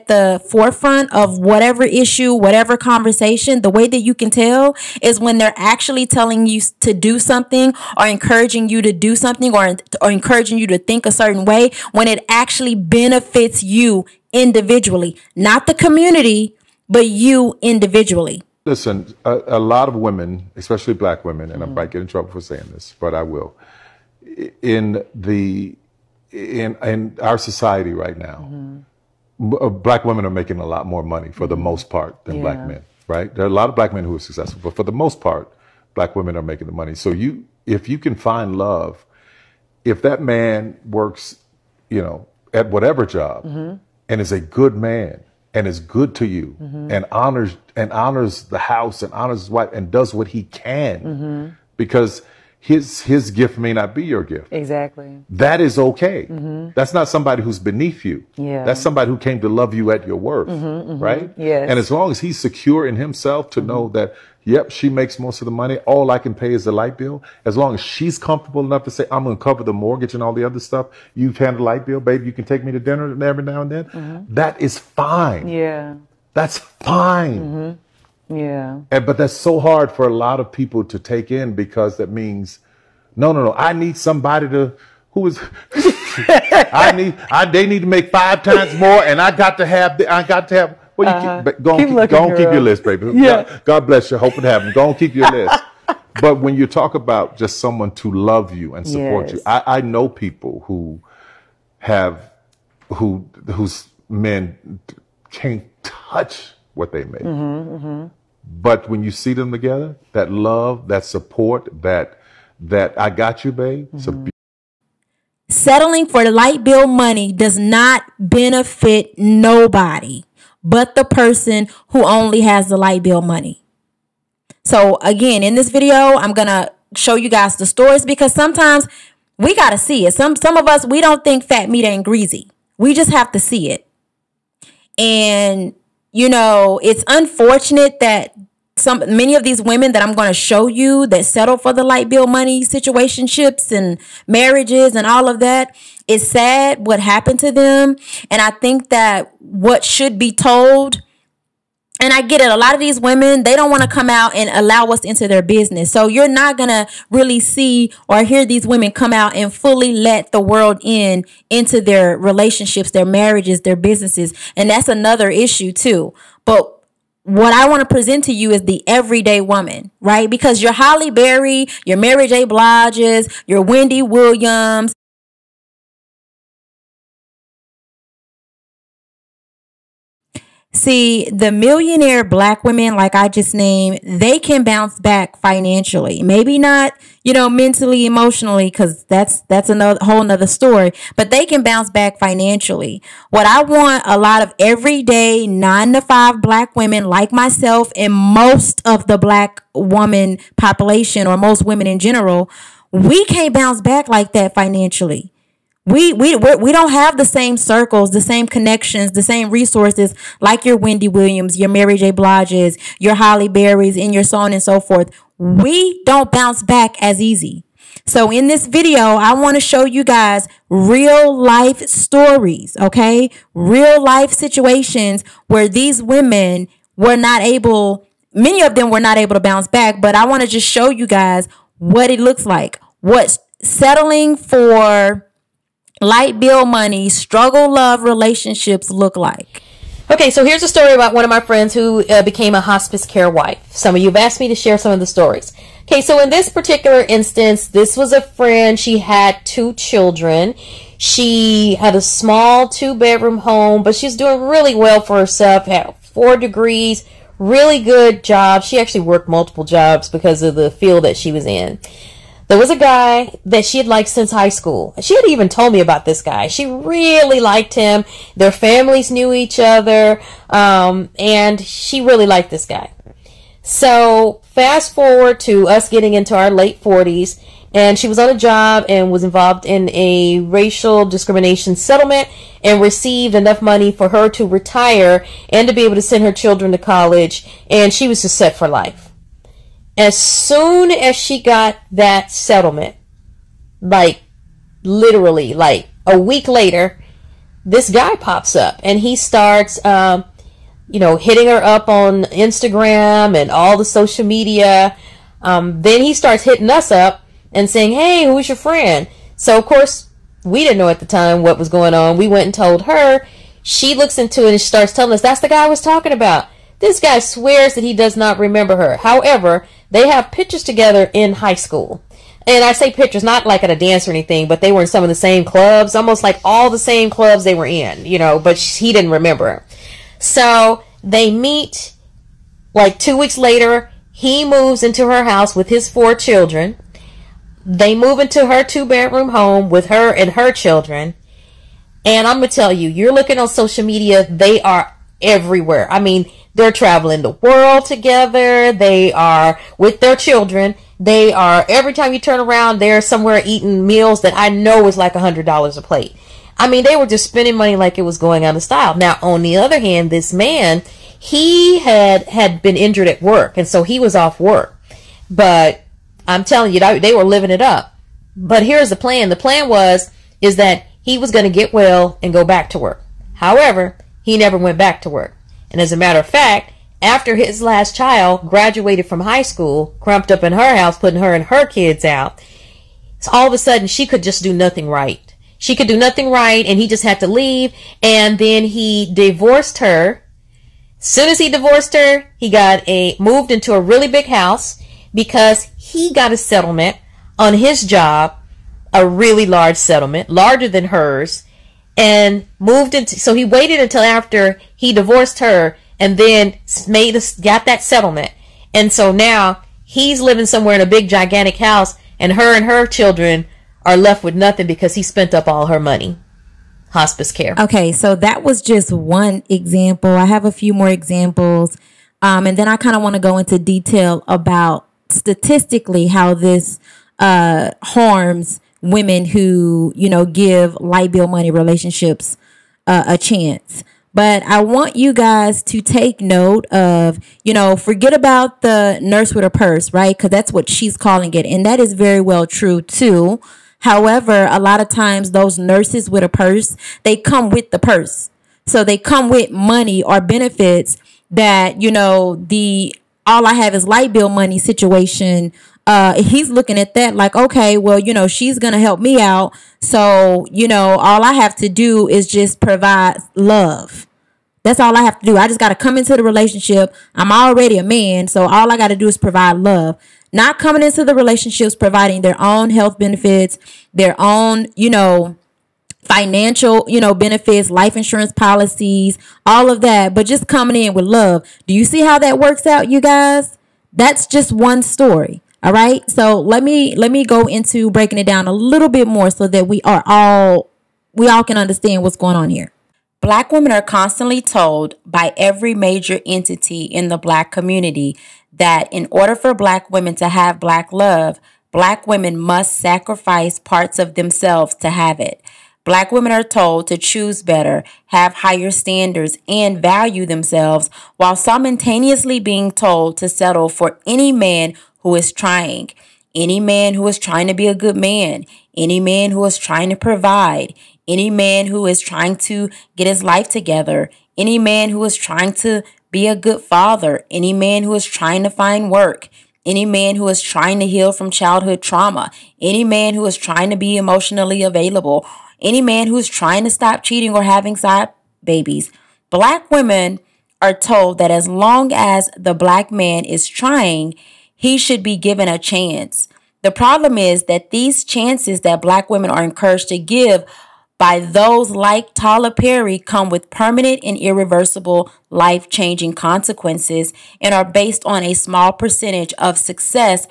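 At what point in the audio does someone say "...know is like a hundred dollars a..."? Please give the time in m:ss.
5:54.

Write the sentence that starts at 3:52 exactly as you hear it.
What settling for light bill money struggle love relationships look like?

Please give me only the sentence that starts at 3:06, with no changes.
Maybe not, you know, mentally, emotionally, because that's that's another whole nother story.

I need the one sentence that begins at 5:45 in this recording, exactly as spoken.
I mean, they're traveling the world together.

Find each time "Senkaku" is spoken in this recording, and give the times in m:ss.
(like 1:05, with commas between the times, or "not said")
not said.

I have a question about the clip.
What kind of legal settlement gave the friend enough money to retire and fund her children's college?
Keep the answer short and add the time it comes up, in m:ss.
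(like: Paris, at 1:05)
racial discrimination settlement, at 4:40.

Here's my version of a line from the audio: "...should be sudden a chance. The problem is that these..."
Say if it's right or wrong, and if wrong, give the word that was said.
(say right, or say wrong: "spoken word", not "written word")
wrong: "given", not "sudden".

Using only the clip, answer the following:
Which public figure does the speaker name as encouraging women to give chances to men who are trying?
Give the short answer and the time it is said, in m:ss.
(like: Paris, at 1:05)
Tyler Perry, at 9:12.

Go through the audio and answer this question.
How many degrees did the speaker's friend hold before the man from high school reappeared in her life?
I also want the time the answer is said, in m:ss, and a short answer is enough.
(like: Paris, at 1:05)
4, at 4:15.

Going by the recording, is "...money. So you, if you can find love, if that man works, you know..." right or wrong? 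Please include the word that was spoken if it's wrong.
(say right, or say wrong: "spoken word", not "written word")
right.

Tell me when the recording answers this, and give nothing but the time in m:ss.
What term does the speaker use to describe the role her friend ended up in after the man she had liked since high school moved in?
4:02.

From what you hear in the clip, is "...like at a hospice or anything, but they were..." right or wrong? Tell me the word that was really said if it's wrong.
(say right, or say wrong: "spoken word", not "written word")
wrong: "dance", not "hospice".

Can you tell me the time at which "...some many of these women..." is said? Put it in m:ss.
2:18.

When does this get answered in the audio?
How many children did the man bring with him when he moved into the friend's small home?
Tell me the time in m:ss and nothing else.
5:35.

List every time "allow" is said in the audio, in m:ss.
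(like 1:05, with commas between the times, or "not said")
2:34.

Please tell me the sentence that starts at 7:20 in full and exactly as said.
Because that's what she's calling it.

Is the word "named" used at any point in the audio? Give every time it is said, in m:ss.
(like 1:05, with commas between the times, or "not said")
3:03.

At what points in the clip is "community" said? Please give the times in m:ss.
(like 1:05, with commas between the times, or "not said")
0:15, 8:17.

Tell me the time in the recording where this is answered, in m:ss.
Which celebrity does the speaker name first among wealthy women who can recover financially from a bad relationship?
2:50.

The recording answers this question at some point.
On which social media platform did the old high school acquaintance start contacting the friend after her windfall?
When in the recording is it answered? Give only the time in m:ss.
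5:02.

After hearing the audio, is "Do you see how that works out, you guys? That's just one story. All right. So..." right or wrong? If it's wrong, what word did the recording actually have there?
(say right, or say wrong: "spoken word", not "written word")
right.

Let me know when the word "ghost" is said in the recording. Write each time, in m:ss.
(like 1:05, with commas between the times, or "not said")
not said.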